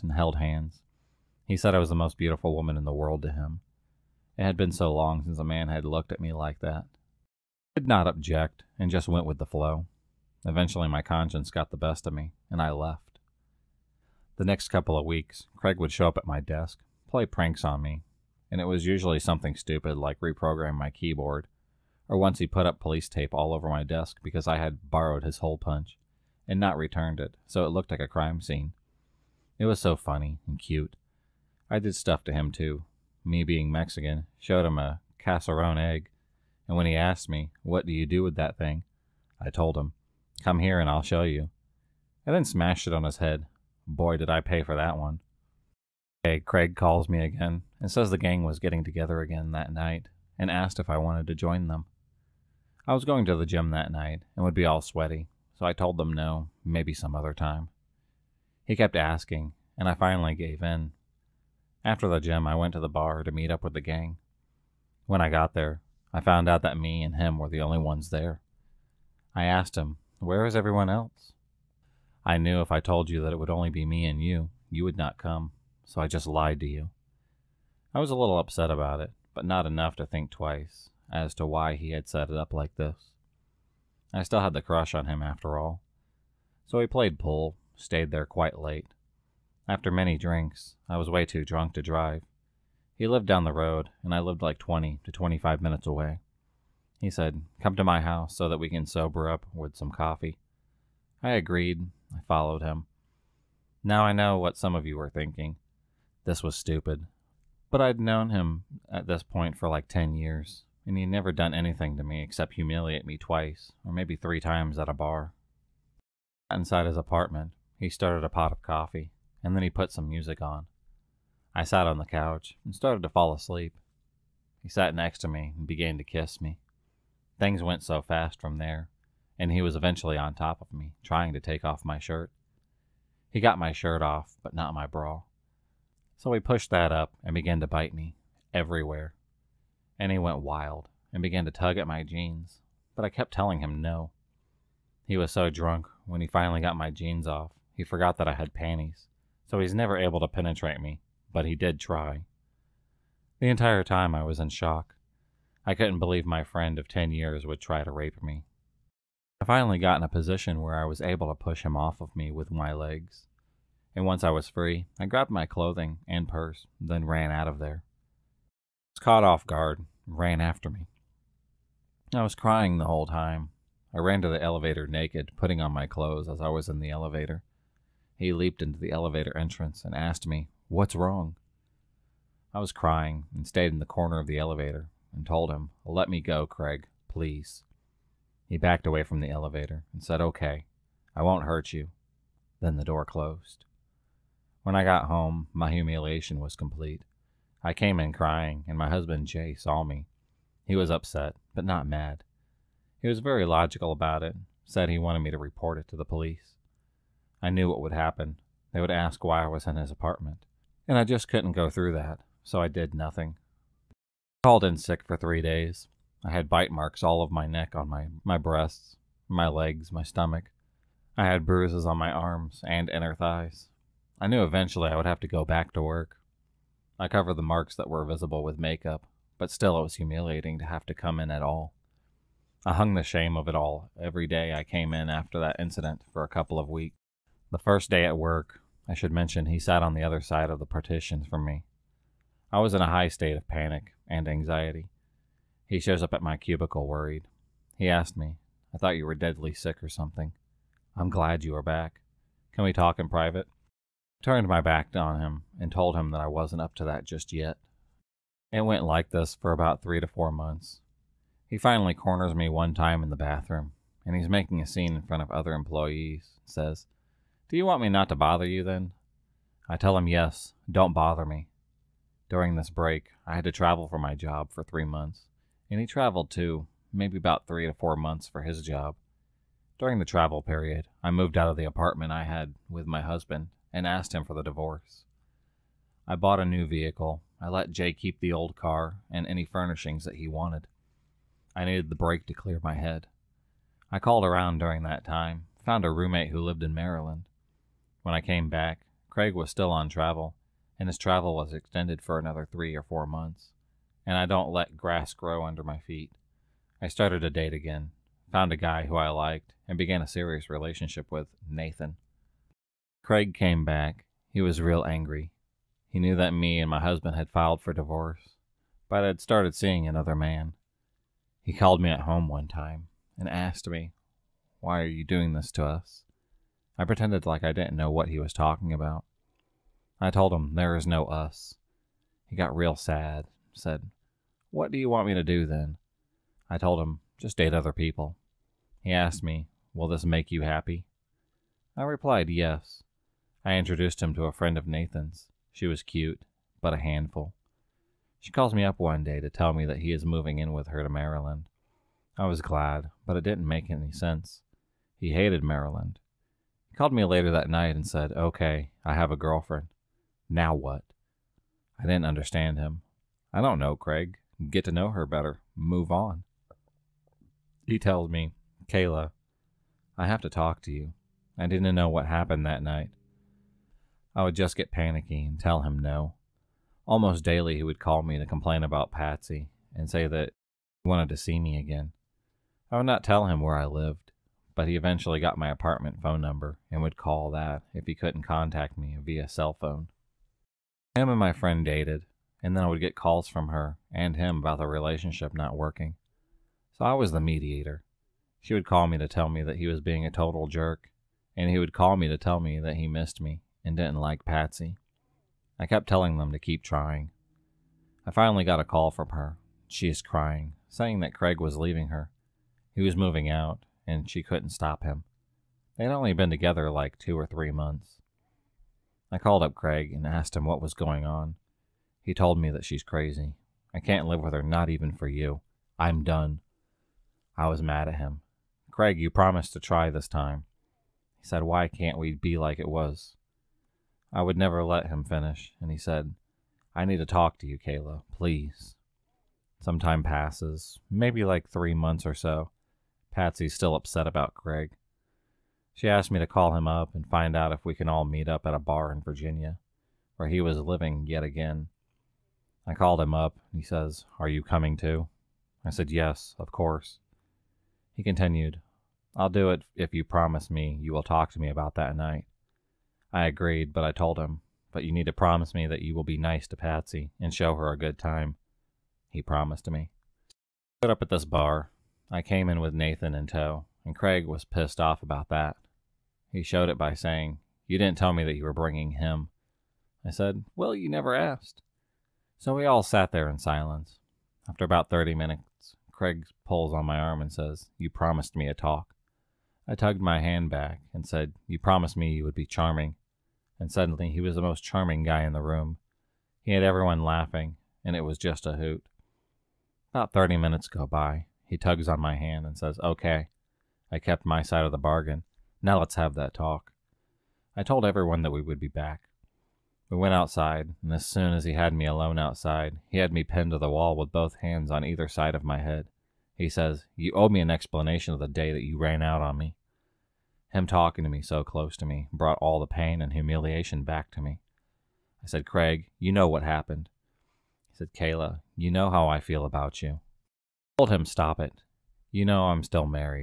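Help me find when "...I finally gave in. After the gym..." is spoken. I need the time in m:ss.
0:59.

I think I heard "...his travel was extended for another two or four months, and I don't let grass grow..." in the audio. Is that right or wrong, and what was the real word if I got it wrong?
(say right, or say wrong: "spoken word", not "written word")
wrong: "three", not "two".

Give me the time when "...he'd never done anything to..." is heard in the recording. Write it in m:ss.
1:50.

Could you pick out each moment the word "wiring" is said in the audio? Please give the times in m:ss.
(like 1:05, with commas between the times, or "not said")
not said.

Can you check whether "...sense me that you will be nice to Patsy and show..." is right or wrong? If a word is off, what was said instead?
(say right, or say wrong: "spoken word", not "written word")
wrong: "promise", not "sense".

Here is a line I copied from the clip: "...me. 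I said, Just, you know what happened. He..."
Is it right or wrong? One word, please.
wrong.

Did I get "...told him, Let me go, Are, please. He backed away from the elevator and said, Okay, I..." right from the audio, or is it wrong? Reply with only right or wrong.
wrong.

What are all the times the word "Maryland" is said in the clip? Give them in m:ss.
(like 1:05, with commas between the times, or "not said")
4:56, 5:50, 5:55.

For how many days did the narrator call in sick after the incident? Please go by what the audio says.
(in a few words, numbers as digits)
3.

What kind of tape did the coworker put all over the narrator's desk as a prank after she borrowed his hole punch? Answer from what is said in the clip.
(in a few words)
police tape.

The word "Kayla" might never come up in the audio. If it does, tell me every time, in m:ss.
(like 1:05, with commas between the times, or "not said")
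6:08, 7:17, 8:47.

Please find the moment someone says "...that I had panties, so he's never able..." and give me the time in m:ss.
2:28.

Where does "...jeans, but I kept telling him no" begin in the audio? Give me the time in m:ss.
2:22.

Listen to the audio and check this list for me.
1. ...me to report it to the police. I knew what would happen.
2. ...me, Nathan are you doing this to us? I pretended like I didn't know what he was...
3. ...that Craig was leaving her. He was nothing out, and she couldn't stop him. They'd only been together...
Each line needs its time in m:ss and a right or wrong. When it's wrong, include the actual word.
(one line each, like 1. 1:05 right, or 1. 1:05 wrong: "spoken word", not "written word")
1. 3:25 right
2. 5:23 wrong: "Why", not "Nathan"
3. 6:51 wrong: "moving", not "nothing".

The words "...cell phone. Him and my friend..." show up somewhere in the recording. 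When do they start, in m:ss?
6:29.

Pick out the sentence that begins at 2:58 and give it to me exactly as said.
He leaped into the elevator entrance and asked me, What's wrong?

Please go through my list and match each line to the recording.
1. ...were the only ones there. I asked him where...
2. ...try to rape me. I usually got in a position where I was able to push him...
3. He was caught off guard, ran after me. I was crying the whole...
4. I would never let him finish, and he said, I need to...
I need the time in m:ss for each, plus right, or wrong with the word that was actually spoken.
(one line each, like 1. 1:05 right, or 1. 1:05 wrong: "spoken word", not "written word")
1. 1:07 right
2. 2:37 wrong: "finally", not "usually"
3. 2:48 right
4. 7:14 right.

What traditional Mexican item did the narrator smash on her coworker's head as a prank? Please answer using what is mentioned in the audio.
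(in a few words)
cascarón egg.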